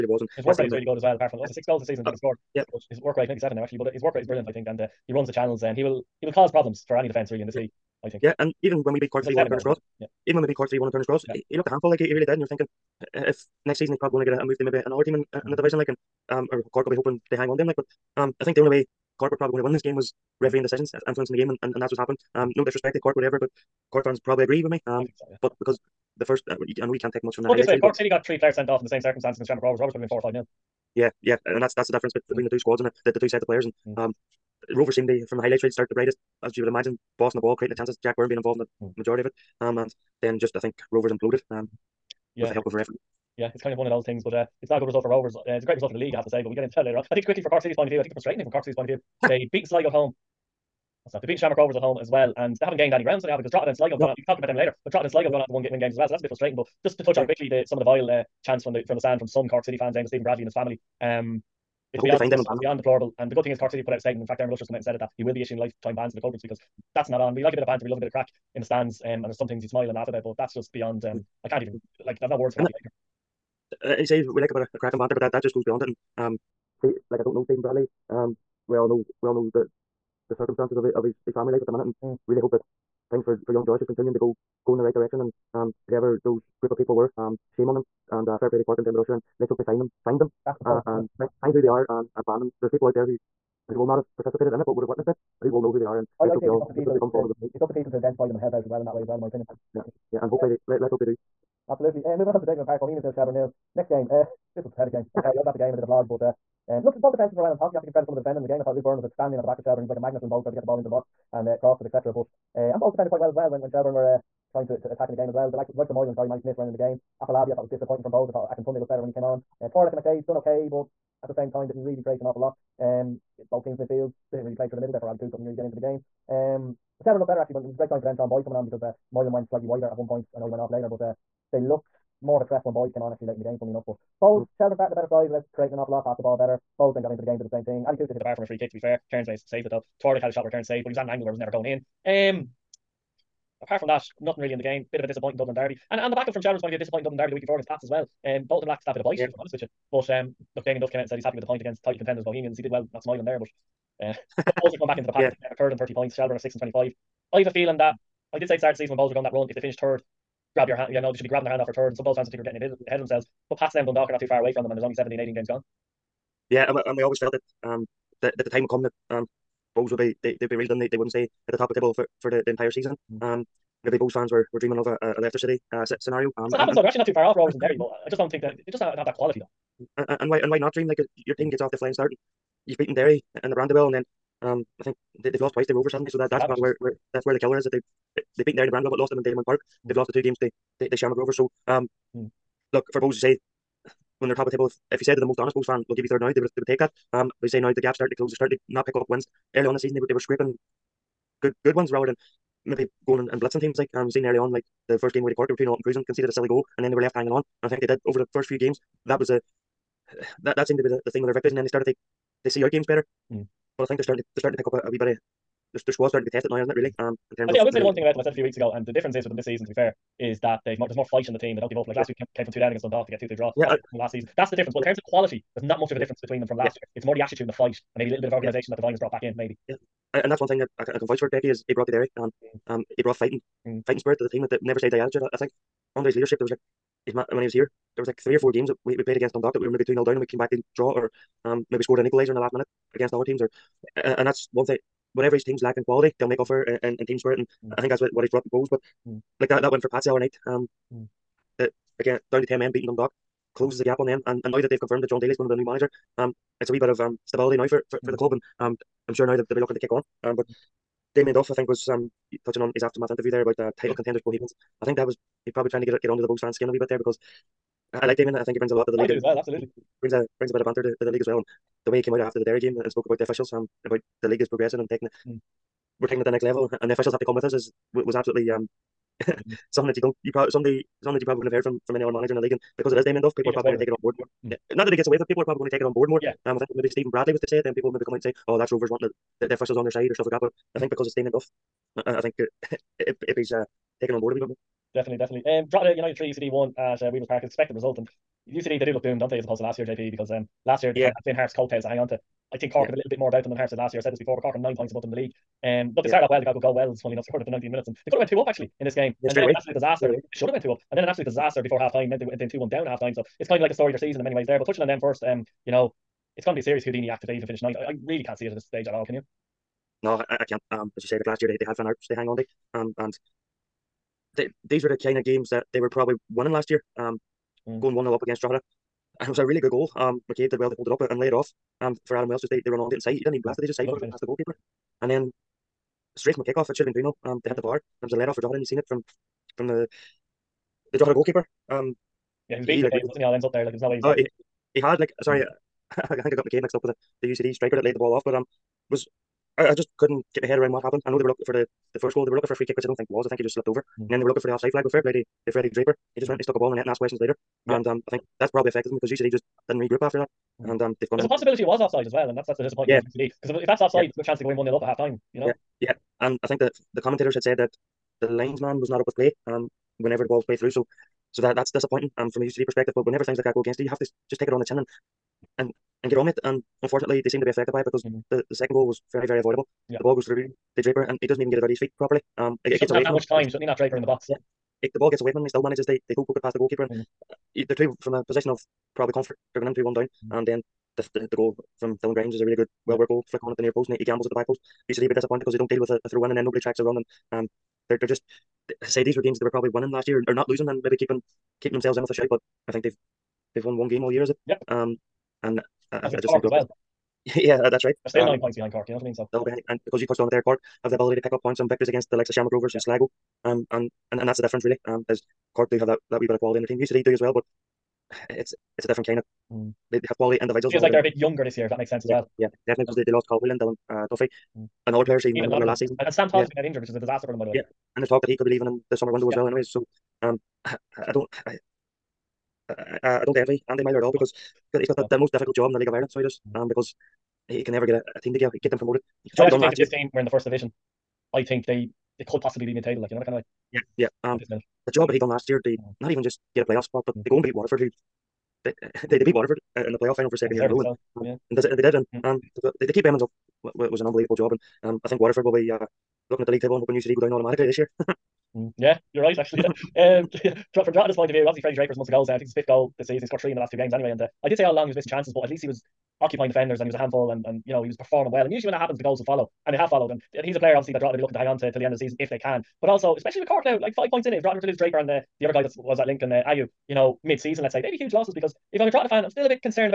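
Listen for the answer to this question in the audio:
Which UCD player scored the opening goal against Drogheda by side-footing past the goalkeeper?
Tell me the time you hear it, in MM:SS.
05:32.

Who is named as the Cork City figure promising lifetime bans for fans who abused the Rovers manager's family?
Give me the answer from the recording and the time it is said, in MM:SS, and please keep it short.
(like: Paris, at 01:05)
Dermot Usher, at 01:28.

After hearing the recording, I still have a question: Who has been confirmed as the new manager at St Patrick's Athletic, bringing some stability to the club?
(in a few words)
John Daly.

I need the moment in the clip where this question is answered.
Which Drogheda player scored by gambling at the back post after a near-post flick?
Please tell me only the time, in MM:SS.
06:32.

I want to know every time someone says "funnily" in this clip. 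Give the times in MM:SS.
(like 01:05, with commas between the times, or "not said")
02:13, 05:07.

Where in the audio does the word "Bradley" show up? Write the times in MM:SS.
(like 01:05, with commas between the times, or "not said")
01:00, 01:17, 04:47.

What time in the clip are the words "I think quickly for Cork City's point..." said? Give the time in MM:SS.
00:47.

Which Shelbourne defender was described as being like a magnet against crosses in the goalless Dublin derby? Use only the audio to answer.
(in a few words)
Luke Byrne.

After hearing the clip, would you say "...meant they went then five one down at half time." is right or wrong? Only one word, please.
wrong.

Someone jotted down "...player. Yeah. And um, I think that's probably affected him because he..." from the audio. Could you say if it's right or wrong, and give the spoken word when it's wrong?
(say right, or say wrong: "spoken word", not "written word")
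wrong: "later", not "player".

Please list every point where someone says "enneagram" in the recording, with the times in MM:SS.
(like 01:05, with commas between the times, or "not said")
not said.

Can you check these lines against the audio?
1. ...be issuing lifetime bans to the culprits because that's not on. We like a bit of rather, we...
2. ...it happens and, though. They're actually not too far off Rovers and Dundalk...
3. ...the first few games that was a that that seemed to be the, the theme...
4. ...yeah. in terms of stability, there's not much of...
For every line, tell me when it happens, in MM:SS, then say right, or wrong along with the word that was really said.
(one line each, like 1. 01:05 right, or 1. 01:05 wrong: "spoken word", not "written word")
1. 01:05 wrong: "banter", not "rather"
2. 02:56 wrong: "Derry", not "Dundalk"
3. 03:28 right
4. 03:44 wrong: "quality", not "stability".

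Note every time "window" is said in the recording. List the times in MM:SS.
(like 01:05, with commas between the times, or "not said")
07:09.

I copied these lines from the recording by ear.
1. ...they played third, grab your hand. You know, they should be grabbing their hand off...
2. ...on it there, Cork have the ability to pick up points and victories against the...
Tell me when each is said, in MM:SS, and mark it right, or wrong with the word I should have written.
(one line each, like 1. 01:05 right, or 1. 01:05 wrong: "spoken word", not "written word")
1. 02:39 wrong: "finished", not "played"
2. 06:50 right.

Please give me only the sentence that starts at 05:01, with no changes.
kind of had Finn Harp's coattails to hang on to.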